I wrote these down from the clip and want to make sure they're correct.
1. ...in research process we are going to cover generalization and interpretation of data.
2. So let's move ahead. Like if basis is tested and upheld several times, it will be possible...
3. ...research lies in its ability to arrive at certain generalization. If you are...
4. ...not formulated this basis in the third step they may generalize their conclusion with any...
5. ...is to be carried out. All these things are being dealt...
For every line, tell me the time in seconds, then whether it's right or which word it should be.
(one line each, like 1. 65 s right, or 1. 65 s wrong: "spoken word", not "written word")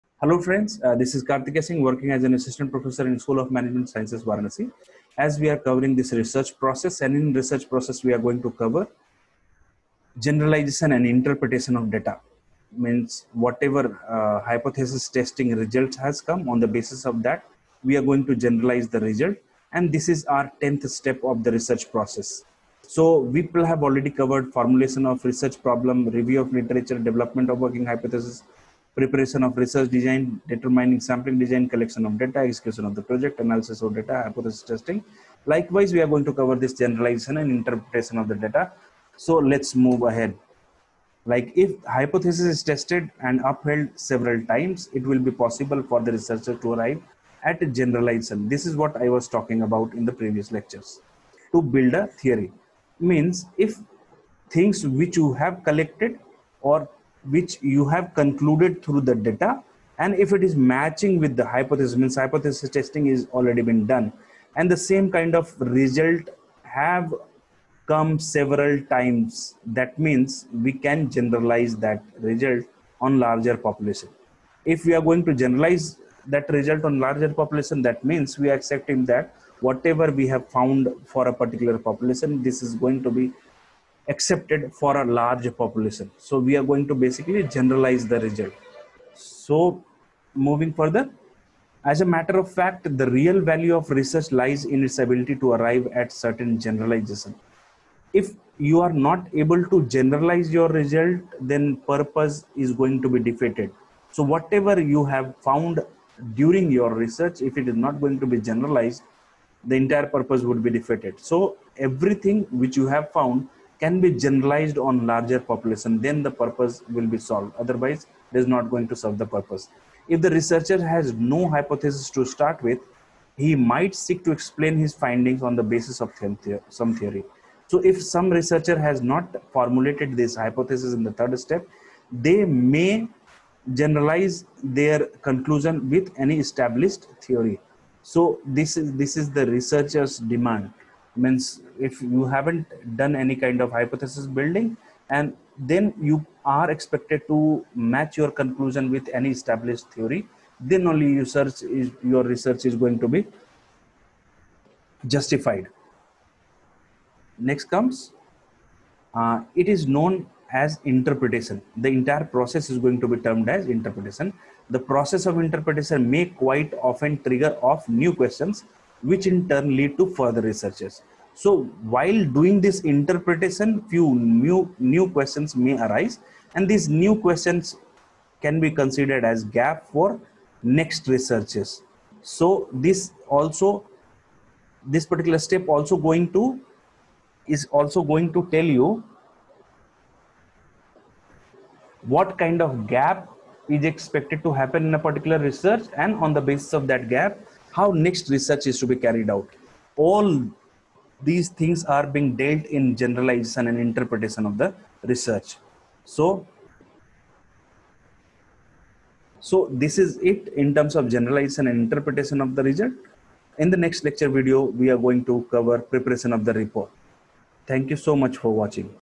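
1. 7 s right
2. 39 s wrong: "hypothesis", not "basis"
3. 93 s right
4. 129 s wrong: "hypothesis", not "basis"
5. 198 s right.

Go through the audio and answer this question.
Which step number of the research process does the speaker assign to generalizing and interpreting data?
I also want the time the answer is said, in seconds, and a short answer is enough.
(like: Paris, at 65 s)
10th, at 20 s.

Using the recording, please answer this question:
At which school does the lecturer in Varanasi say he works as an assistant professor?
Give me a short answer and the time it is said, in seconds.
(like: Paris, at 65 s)
School of Management Sciences, at 3 s.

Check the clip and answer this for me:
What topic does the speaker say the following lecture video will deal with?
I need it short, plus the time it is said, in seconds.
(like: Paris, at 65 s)
preparation of the report, at 215 s.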